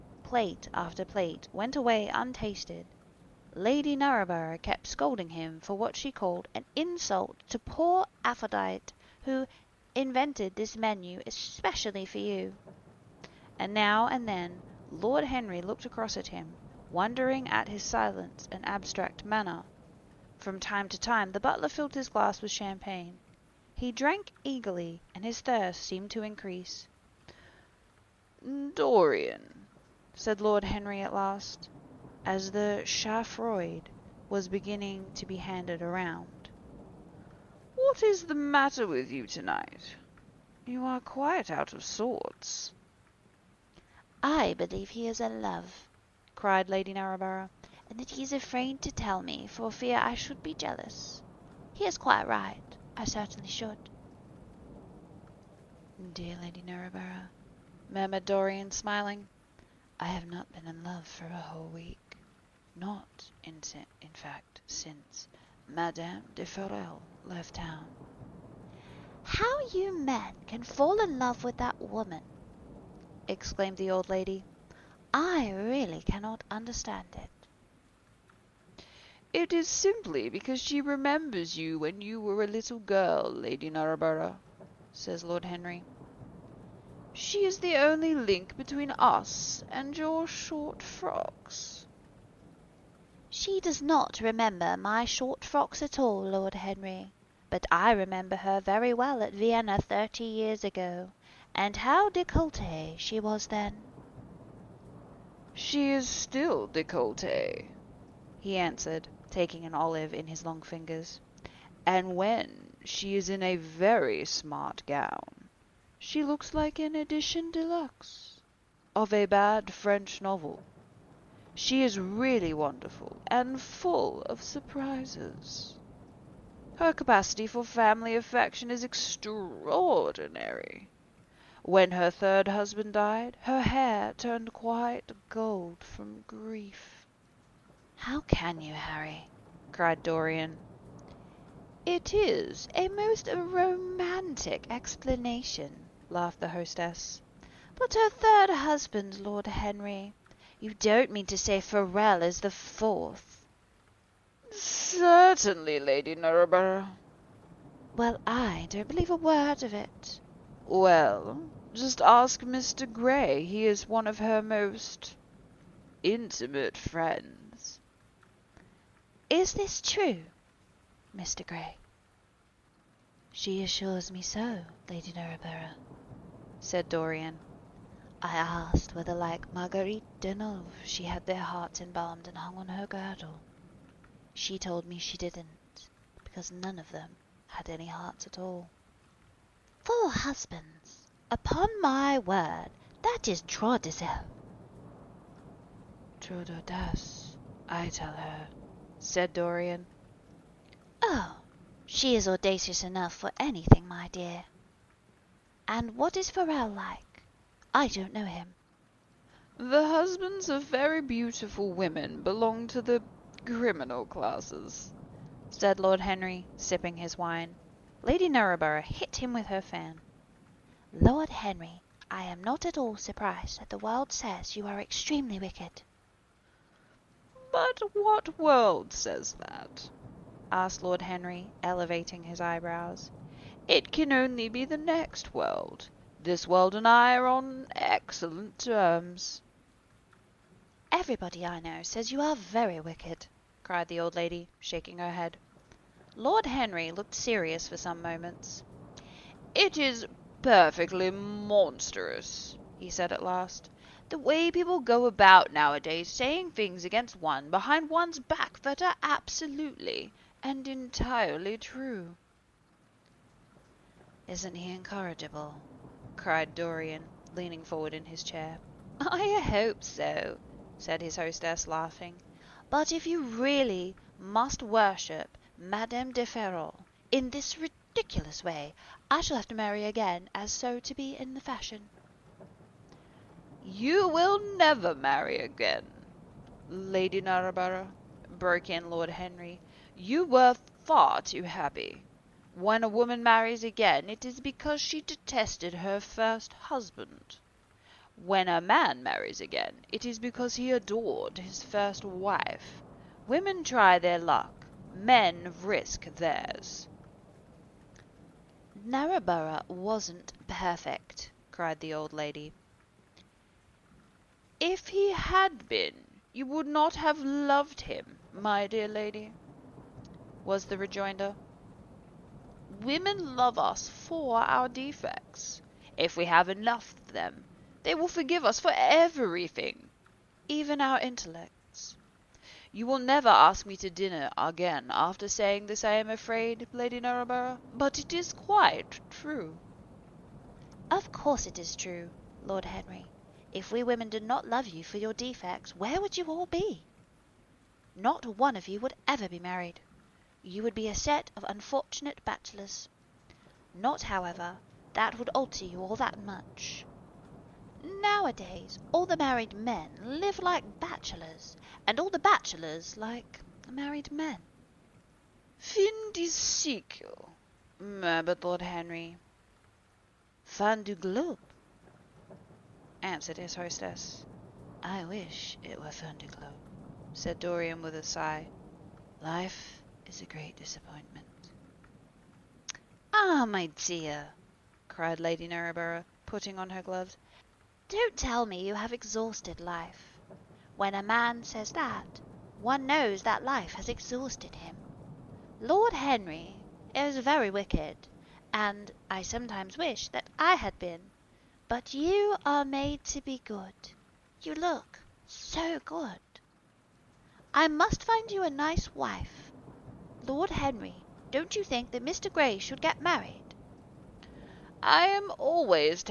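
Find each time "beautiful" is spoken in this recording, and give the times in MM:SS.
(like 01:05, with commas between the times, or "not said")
03:31.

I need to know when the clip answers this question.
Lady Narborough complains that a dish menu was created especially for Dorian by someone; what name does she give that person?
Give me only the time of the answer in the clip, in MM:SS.
00:08.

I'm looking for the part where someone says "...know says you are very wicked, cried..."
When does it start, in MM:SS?
04:01.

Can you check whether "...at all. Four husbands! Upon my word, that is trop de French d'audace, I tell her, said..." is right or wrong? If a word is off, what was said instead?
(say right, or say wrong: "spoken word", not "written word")
wrong: "Trop", not "French".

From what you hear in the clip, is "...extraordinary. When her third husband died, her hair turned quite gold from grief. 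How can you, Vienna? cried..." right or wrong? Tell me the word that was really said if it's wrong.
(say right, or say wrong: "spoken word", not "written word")
wrong: "Harry", not "Vienna".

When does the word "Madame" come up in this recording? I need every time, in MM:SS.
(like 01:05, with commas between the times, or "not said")
01:05, 04:35.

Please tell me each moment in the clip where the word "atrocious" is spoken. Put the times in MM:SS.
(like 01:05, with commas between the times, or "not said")
not said.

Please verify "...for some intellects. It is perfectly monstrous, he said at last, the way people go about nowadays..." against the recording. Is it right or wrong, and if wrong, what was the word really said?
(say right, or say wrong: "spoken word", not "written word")
wrong: "moments", not "intellects".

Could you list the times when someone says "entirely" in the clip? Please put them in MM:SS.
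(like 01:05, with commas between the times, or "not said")
04:20.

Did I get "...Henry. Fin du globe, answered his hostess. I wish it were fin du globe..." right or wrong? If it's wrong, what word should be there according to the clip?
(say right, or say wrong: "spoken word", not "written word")
right.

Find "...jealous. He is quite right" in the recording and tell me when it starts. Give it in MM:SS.
00:50.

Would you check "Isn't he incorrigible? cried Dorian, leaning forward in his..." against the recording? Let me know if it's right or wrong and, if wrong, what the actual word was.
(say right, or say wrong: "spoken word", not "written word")
right.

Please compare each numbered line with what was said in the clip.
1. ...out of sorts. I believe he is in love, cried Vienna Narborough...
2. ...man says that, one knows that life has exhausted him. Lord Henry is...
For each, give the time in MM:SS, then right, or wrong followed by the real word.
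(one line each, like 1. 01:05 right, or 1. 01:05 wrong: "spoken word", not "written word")
1. 00:41 wrong: "Lady", not "Vienna"
2. 06:31 right.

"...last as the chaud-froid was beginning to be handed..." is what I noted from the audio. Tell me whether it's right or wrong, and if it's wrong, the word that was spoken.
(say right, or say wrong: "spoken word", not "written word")
right.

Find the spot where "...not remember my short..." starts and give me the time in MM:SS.
01:33.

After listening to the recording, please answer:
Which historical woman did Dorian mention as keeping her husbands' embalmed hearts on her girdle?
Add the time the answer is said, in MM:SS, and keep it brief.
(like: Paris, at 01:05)
Marguerite Deneuve, at 02:59.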